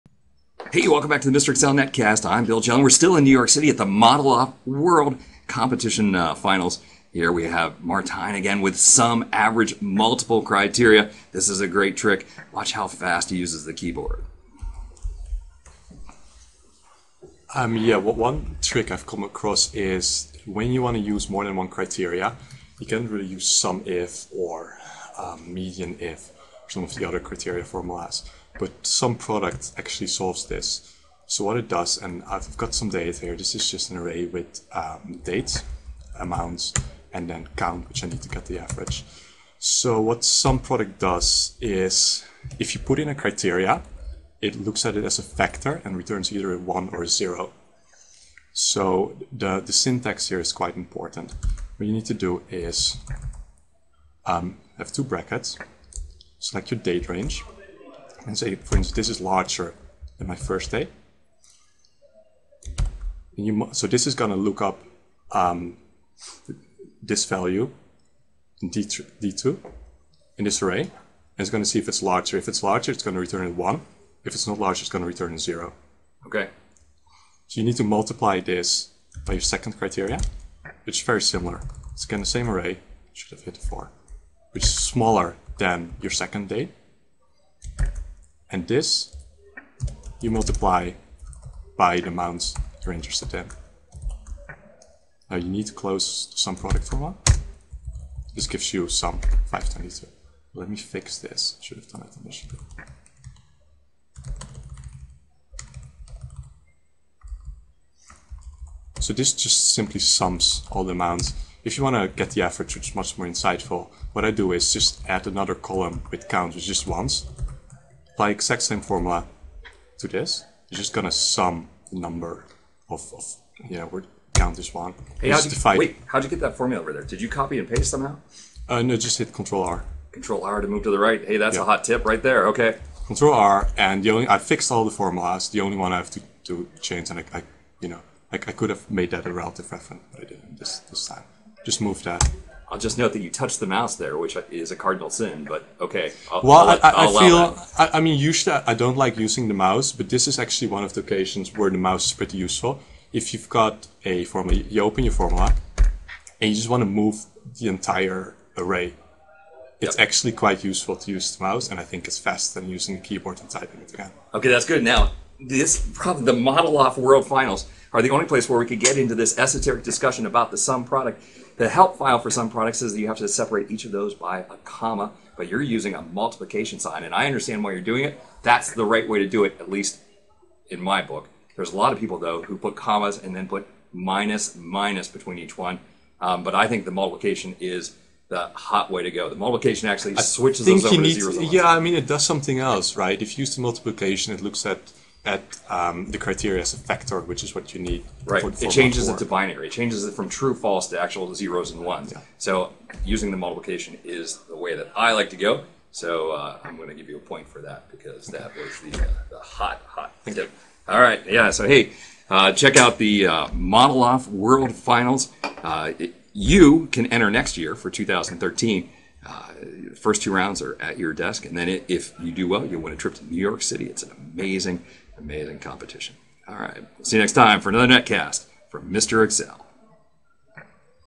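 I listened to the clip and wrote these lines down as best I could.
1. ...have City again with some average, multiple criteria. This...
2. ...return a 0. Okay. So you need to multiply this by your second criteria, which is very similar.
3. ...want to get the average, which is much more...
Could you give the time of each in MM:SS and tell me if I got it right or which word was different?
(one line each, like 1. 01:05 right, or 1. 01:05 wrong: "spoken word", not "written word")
1. 00:07 wrong: "Martijn", not "City"
2. 01:15 right
3. 01:51 right.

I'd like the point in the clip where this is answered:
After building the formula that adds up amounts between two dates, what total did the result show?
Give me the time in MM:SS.
01:39.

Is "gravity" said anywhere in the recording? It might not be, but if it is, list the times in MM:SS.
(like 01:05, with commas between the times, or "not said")
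not said.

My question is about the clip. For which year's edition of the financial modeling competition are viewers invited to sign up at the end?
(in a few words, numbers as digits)
2013.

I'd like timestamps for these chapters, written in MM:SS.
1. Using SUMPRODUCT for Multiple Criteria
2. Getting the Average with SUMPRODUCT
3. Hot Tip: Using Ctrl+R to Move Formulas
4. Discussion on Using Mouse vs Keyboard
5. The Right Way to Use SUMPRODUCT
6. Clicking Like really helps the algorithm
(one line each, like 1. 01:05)
1. 00:18
2. 01:16
3. 02:03
4. 02:26
5. 03:01
6. 03:30.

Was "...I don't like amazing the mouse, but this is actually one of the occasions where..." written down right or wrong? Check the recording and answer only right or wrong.
wrong.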